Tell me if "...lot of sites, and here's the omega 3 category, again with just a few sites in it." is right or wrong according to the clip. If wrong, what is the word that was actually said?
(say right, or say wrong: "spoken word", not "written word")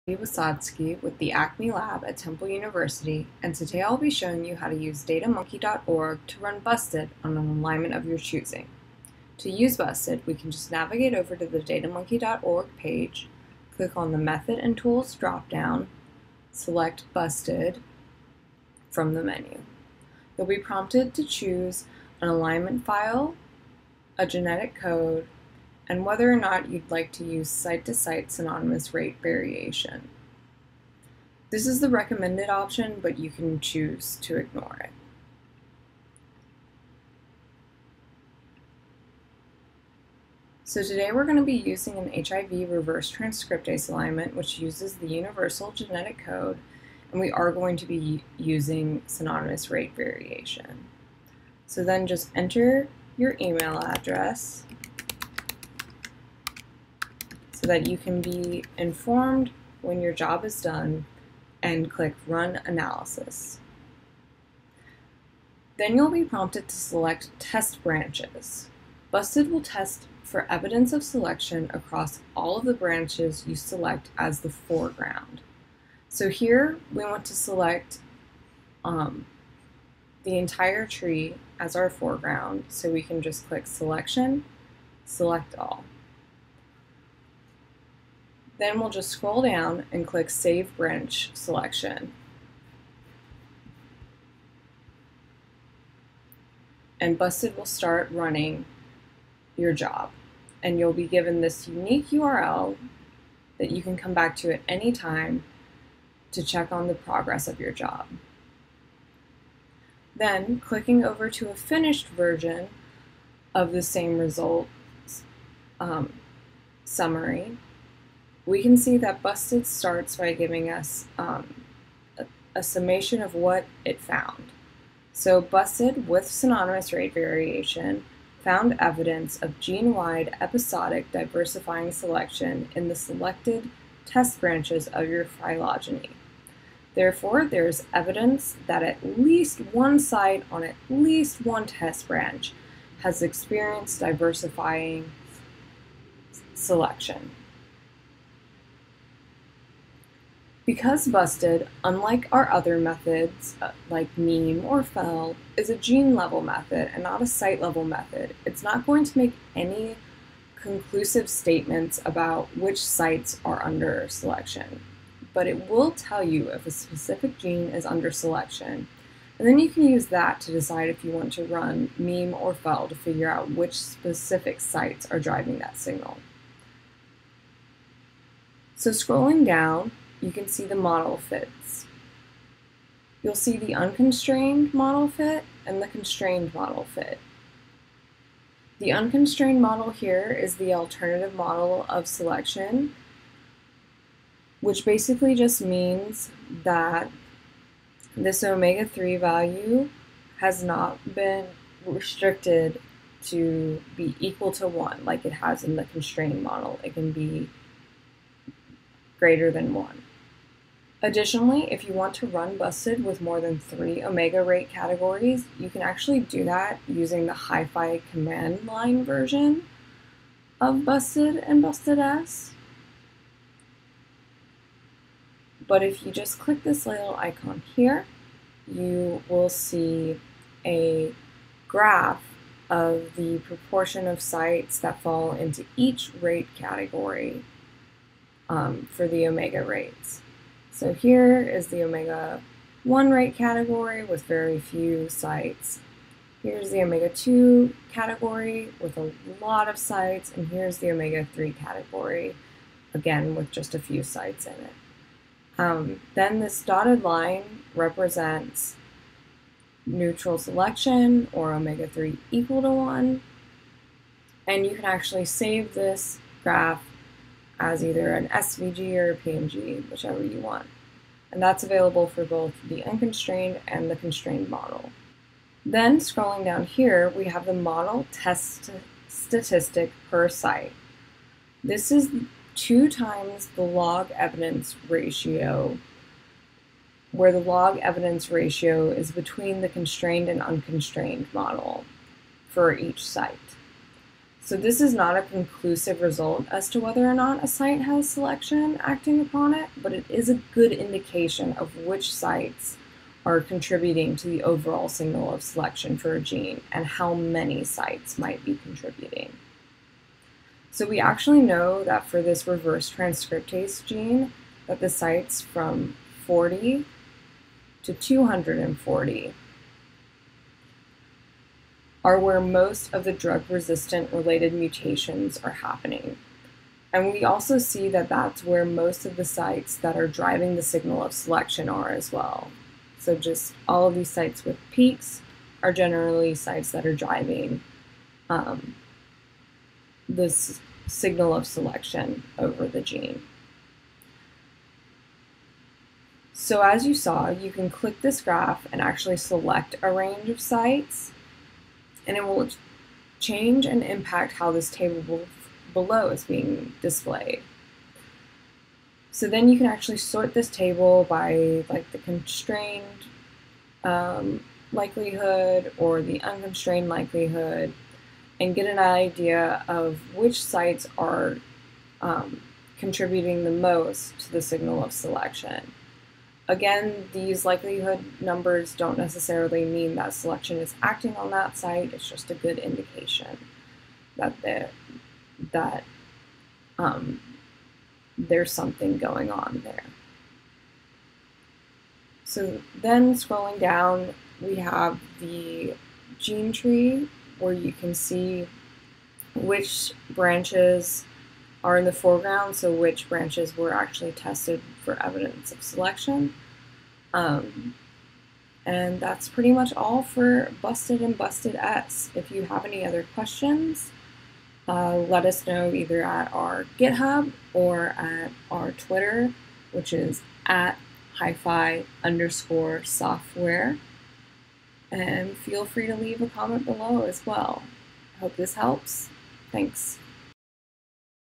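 right.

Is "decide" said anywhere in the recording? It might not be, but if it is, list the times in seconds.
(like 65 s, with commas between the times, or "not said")
170 s.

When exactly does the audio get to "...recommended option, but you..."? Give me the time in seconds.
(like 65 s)
31 s.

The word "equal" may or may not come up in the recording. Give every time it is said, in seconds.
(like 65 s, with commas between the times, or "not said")
204 s, 262 s.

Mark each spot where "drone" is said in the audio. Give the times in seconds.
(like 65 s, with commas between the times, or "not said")
not said.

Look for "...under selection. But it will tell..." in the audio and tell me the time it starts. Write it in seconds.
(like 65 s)
163 s.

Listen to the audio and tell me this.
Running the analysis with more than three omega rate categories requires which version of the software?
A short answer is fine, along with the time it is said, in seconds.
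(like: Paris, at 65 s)
HyPhy command line, at 217 s.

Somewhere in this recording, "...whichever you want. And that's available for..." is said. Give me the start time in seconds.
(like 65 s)
269 s.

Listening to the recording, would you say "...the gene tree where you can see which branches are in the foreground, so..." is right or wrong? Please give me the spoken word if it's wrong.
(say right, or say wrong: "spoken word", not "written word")
right.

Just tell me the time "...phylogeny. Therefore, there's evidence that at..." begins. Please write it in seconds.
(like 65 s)
135 s.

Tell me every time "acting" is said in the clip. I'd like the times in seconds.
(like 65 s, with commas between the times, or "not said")
298 s, 380 s.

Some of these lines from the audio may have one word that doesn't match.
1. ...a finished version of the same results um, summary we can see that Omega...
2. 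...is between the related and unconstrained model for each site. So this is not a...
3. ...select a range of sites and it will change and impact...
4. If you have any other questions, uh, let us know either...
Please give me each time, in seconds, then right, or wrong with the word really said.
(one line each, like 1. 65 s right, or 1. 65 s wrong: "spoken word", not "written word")
1. 111 s wrong: "Busted", not "Omega"
2. 288 s wrong: "constrained", not "related"
3. 349 s right
4. 412 s right.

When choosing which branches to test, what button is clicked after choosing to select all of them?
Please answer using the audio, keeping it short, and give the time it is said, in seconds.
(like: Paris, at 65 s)
Save Branch Selection, at 90 s.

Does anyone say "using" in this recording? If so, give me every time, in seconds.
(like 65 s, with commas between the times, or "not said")
41 s, 48 s, 216 s.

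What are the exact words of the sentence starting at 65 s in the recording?
Then you'll be prompted to select Test Branches.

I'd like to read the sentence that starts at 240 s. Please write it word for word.
So here is the omega 1 rate category with very few sites.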